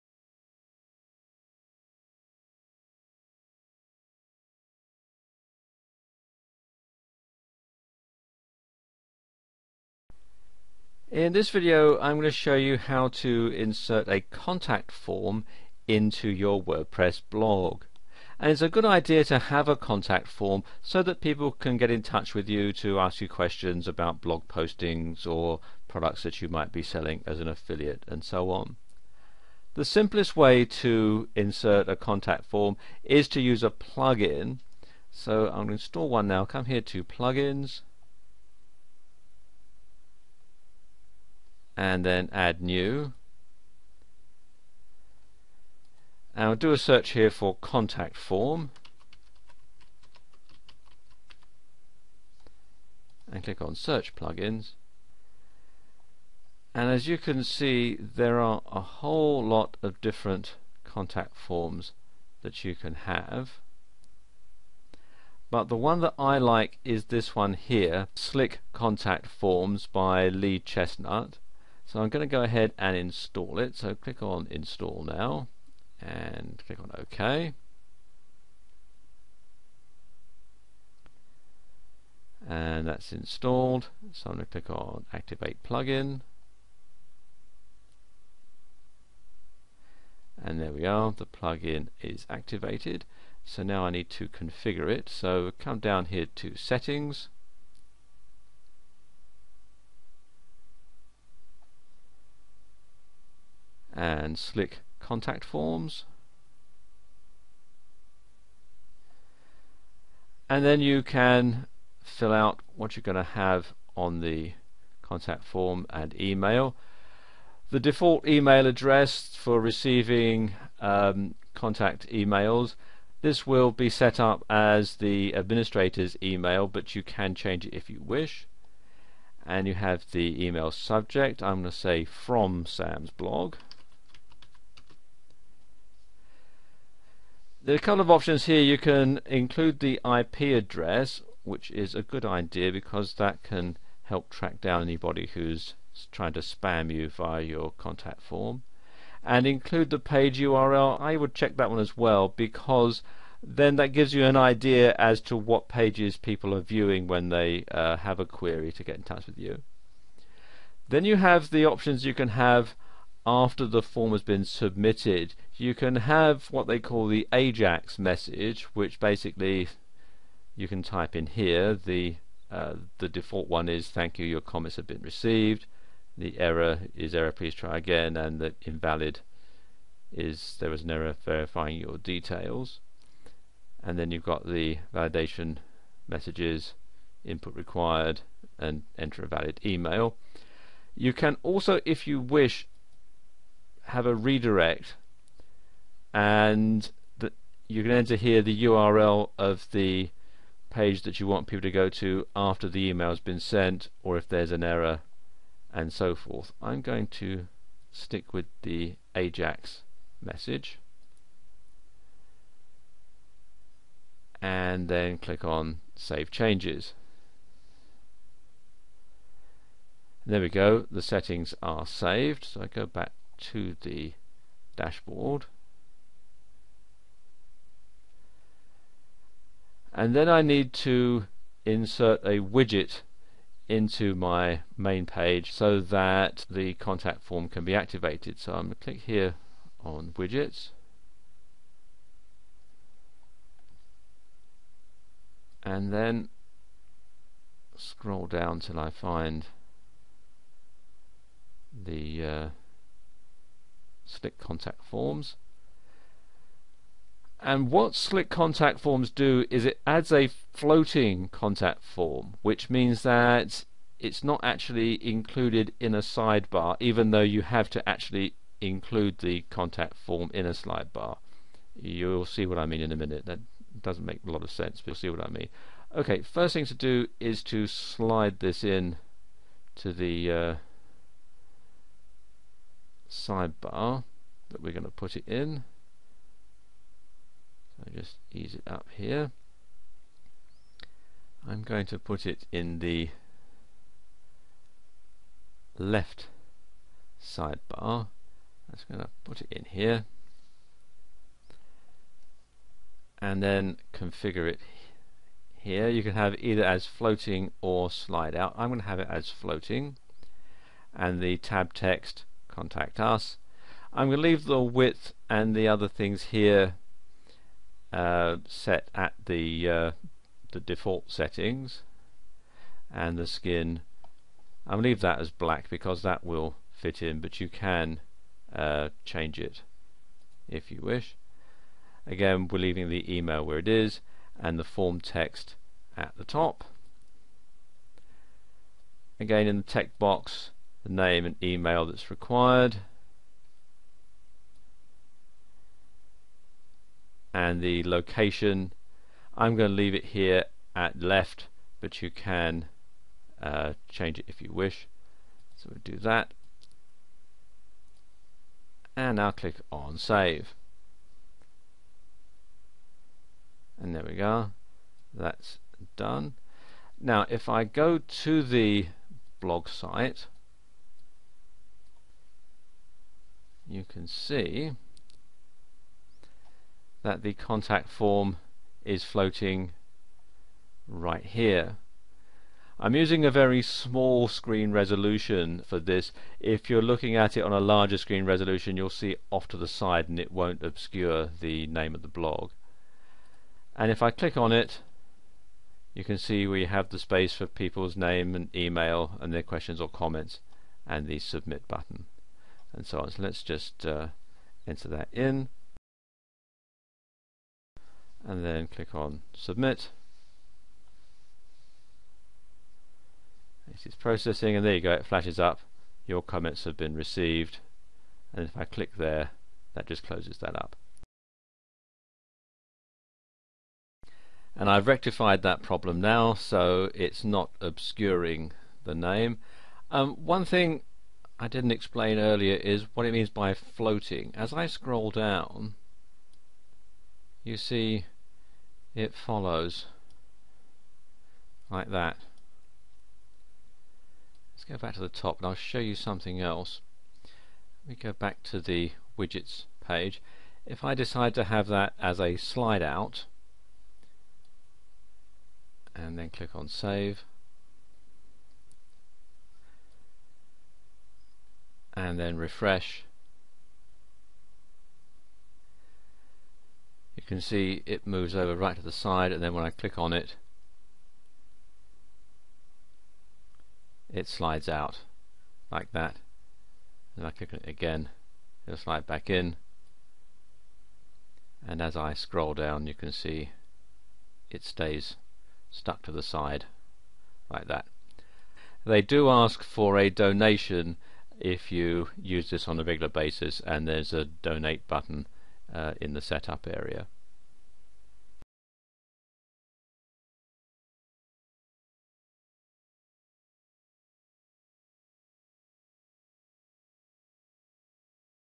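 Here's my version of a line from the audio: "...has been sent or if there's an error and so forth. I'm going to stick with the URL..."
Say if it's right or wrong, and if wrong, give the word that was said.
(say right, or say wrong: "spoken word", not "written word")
wrong: "AJAX", not "URL".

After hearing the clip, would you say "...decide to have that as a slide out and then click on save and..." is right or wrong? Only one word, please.
right.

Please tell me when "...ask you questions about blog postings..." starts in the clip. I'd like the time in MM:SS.
00:22.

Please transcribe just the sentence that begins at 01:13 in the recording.
So click on install now and click on OK.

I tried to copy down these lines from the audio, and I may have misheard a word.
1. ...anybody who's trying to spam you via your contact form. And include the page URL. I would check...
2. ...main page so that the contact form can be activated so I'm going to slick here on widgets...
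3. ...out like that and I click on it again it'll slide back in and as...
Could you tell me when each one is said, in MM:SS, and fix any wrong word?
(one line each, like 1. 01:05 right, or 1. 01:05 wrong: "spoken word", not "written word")
1. 02:24 right
2. 03:54 wrong: "click", not "slick"
3. 07:54 right.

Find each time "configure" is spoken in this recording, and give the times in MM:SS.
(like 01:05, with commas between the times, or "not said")
01:34, 05:03.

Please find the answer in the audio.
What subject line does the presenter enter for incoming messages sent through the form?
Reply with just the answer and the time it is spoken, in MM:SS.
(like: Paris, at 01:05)
From Sam's blog, at 02:12.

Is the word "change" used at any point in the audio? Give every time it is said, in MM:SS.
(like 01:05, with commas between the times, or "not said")
02:07, 03:36, 05:29, 05:53.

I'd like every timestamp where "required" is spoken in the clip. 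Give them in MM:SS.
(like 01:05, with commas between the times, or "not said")
03:07, 05:42.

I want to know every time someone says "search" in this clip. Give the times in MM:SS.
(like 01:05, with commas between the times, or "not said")
00:46, 00:53.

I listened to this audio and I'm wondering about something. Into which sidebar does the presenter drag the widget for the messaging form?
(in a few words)
Left sidebar.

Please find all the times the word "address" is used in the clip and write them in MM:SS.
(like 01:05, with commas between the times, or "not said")
01:58, 02:20.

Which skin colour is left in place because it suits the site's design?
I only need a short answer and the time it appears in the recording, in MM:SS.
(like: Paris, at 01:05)
Black, at 05:25.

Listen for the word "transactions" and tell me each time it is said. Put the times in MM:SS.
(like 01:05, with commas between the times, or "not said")
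not said.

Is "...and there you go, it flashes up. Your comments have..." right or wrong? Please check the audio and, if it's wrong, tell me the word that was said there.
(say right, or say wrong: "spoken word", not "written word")
right.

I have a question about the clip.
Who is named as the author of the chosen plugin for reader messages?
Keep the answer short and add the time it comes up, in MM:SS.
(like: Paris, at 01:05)
Lee Chestnut, at 01:10.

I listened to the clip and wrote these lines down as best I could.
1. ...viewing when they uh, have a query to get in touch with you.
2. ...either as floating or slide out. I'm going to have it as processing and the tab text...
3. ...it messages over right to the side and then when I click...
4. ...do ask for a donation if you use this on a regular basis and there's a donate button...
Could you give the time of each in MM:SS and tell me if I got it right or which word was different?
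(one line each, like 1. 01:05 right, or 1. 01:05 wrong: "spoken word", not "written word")
1. 02:36 right
2. 05:06 wrong: "floating", not "processing"
3. 07:47 wrong: "moves", not "messages"
4. 08:09 right.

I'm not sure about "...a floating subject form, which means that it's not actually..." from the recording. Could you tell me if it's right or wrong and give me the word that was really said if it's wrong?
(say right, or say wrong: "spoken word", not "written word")
wrong: "contact", not "subject".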